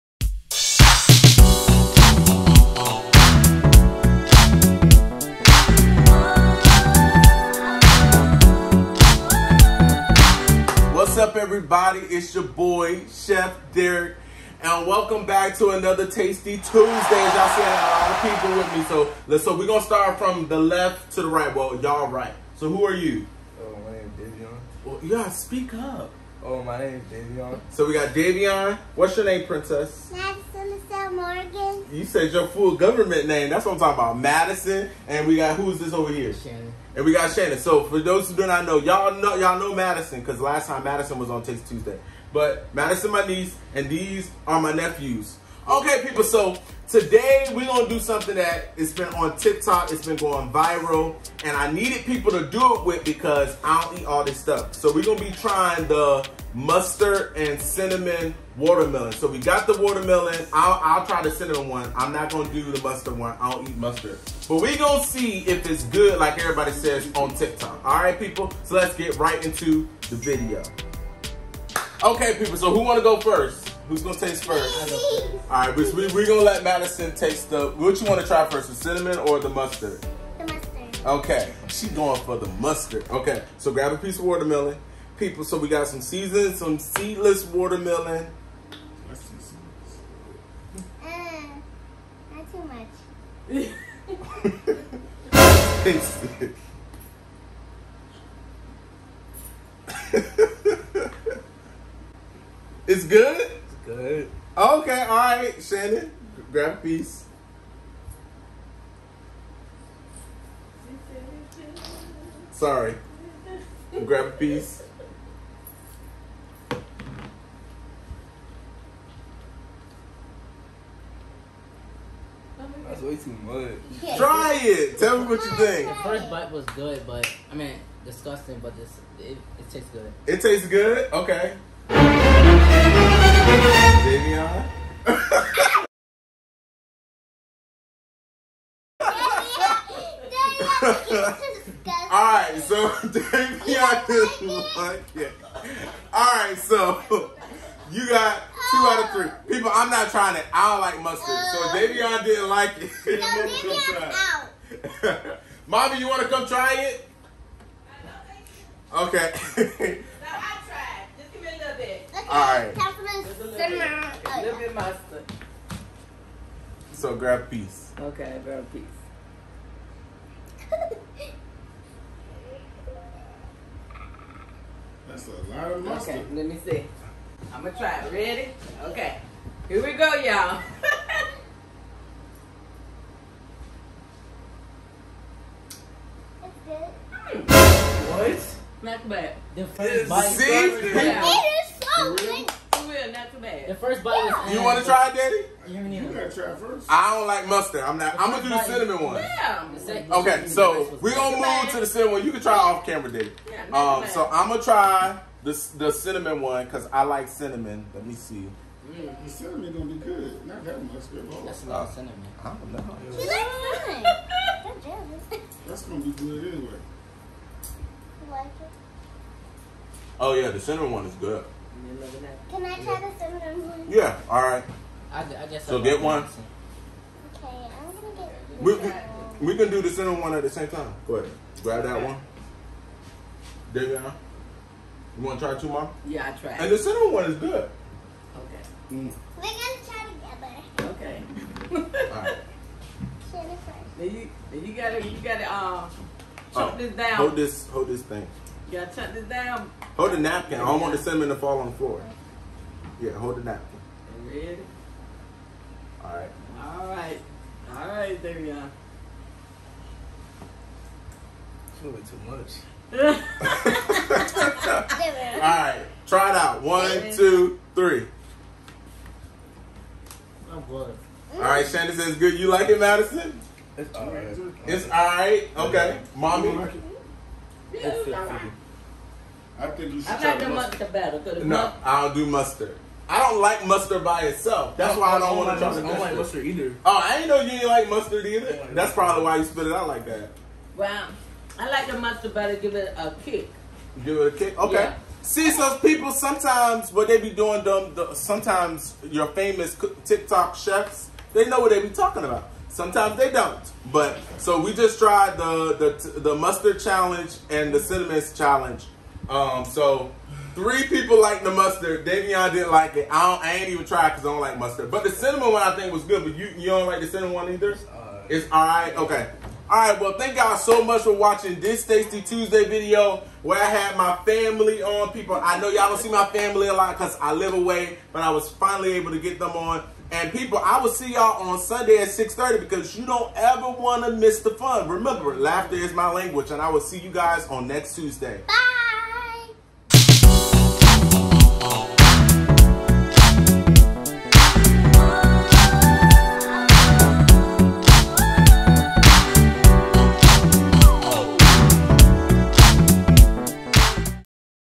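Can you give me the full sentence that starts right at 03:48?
We, we, we, can do the cinnamon one at the same time.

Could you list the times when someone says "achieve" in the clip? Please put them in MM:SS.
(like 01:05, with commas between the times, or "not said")
not said.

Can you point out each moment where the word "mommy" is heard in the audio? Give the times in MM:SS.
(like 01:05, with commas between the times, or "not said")
02:35, 04:36.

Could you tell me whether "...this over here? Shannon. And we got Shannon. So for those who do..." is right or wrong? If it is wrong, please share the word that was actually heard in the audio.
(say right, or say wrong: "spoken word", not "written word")
right.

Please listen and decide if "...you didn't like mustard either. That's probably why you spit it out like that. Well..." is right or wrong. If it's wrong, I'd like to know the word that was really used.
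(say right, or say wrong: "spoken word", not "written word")
right.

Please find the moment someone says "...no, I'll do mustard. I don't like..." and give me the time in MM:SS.
04:41.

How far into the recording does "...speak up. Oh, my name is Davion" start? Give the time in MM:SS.
00:25.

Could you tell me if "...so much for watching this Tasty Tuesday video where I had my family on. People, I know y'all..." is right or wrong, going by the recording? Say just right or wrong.
right.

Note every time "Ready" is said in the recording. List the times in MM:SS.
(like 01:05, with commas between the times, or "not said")
02:58, 04:14.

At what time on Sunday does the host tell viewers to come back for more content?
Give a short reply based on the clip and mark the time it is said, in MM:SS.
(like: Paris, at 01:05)
6:30, at 05:32.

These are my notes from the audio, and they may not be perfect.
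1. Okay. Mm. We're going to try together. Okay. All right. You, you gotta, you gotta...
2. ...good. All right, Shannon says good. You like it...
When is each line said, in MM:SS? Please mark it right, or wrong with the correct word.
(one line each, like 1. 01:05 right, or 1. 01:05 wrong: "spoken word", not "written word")
1. 03:58 right
2. 04:30 right.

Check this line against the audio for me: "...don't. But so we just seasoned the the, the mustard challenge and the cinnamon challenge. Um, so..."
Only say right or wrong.
wrong.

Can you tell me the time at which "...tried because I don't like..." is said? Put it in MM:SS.
05:13.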